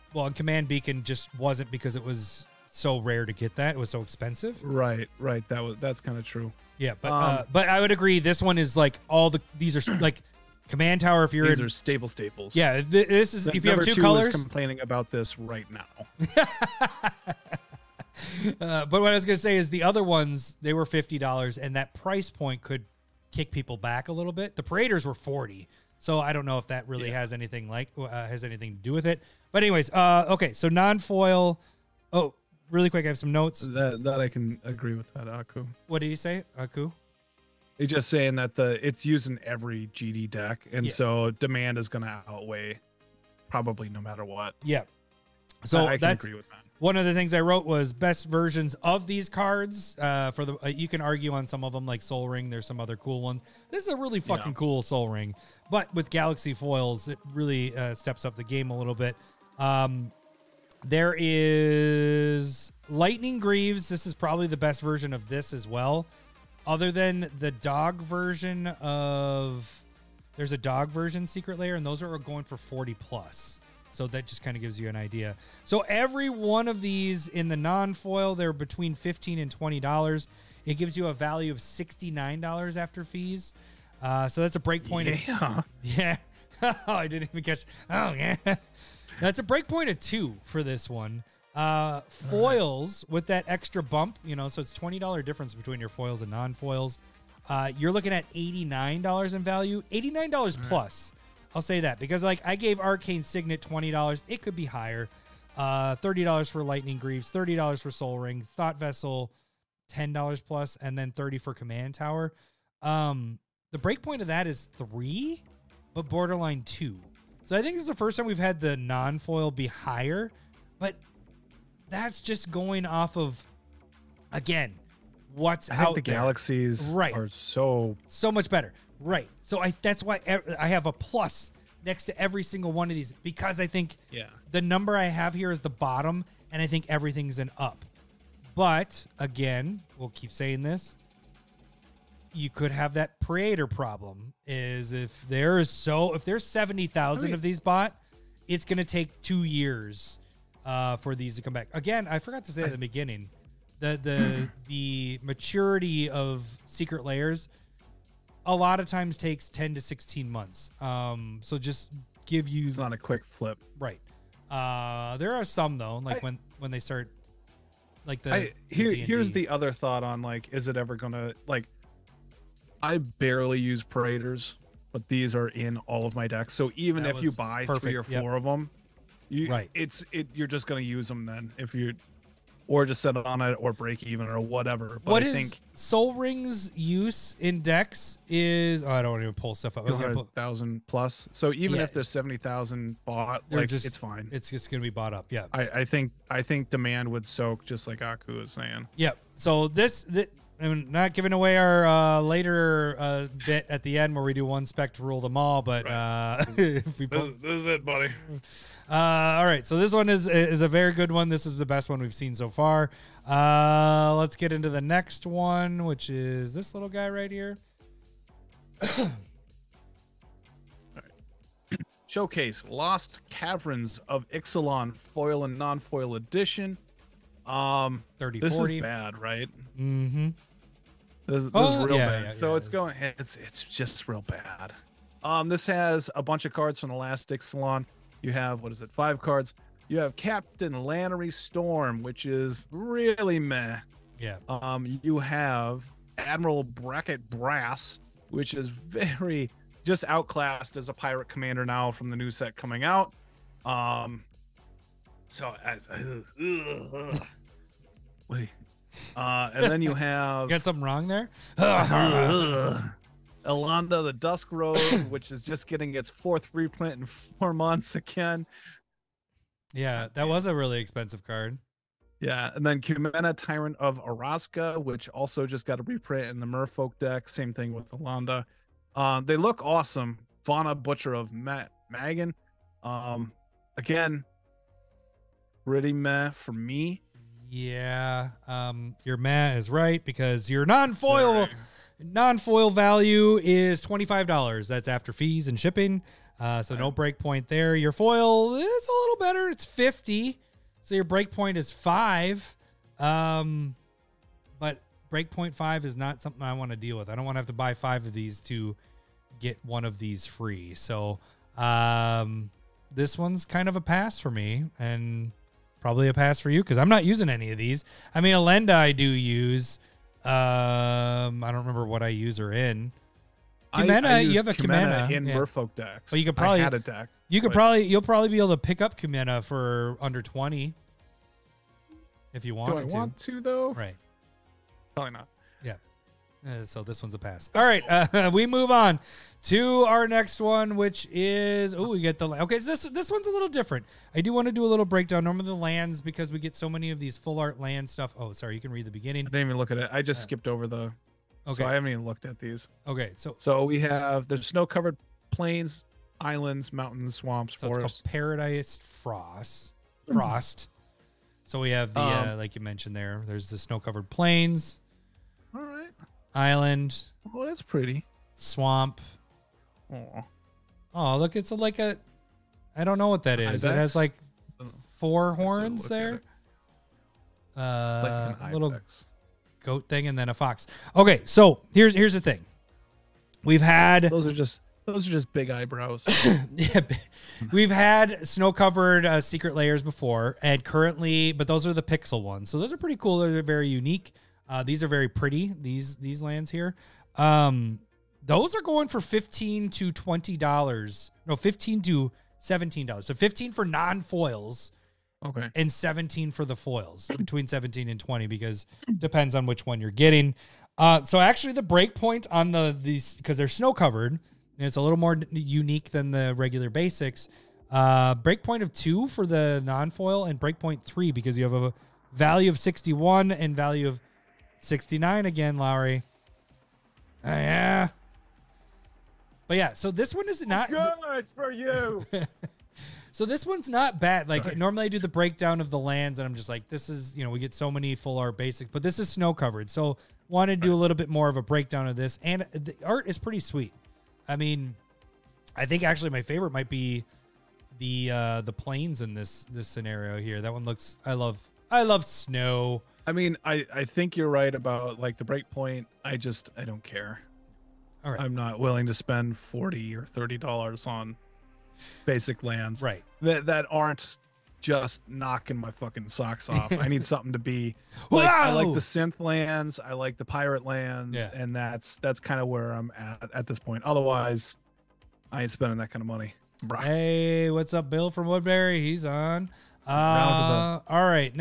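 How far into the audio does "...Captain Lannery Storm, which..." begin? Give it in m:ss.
4:00.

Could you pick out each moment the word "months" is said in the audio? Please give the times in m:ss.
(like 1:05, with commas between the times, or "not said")
2:40, 4:27.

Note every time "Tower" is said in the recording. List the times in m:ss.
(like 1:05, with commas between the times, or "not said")
0:11, 1:51.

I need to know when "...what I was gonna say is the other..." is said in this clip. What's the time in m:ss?
0:19.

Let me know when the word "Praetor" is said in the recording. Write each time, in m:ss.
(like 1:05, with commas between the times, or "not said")
2:23, 2:53.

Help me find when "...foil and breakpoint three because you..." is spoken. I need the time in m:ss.
6:59.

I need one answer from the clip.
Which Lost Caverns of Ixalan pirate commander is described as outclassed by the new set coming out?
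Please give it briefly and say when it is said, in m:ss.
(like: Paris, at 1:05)
Admiral Beckett Brass, at 4:06.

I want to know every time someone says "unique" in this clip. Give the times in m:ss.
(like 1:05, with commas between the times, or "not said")
6:33, 6:55.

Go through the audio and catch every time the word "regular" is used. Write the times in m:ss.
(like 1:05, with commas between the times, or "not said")
6:56.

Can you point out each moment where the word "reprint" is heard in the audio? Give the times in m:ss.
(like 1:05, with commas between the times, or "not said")
4:26, 4:35.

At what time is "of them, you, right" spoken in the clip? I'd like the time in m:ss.
2:58.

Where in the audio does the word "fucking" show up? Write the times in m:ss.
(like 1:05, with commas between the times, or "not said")
0:54, 7:45.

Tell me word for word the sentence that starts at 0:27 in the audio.
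has anything like uh, has anything to do with it.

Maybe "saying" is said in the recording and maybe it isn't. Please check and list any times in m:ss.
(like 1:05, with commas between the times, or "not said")
0:38, 2:20, 3:18.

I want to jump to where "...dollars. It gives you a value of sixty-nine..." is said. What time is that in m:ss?
1:19.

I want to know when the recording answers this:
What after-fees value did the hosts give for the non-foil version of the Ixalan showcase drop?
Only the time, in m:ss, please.
4:53.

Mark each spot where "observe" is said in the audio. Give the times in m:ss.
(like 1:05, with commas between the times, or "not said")
not said.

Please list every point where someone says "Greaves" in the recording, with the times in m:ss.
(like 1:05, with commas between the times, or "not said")
1:03, 1:46.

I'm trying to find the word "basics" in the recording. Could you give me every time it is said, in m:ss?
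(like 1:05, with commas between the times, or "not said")
6:56, 7:18, 7:42.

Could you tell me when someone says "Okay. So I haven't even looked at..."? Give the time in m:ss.
5:51.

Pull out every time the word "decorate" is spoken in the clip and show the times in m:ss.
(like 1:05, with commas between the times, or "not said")
not said.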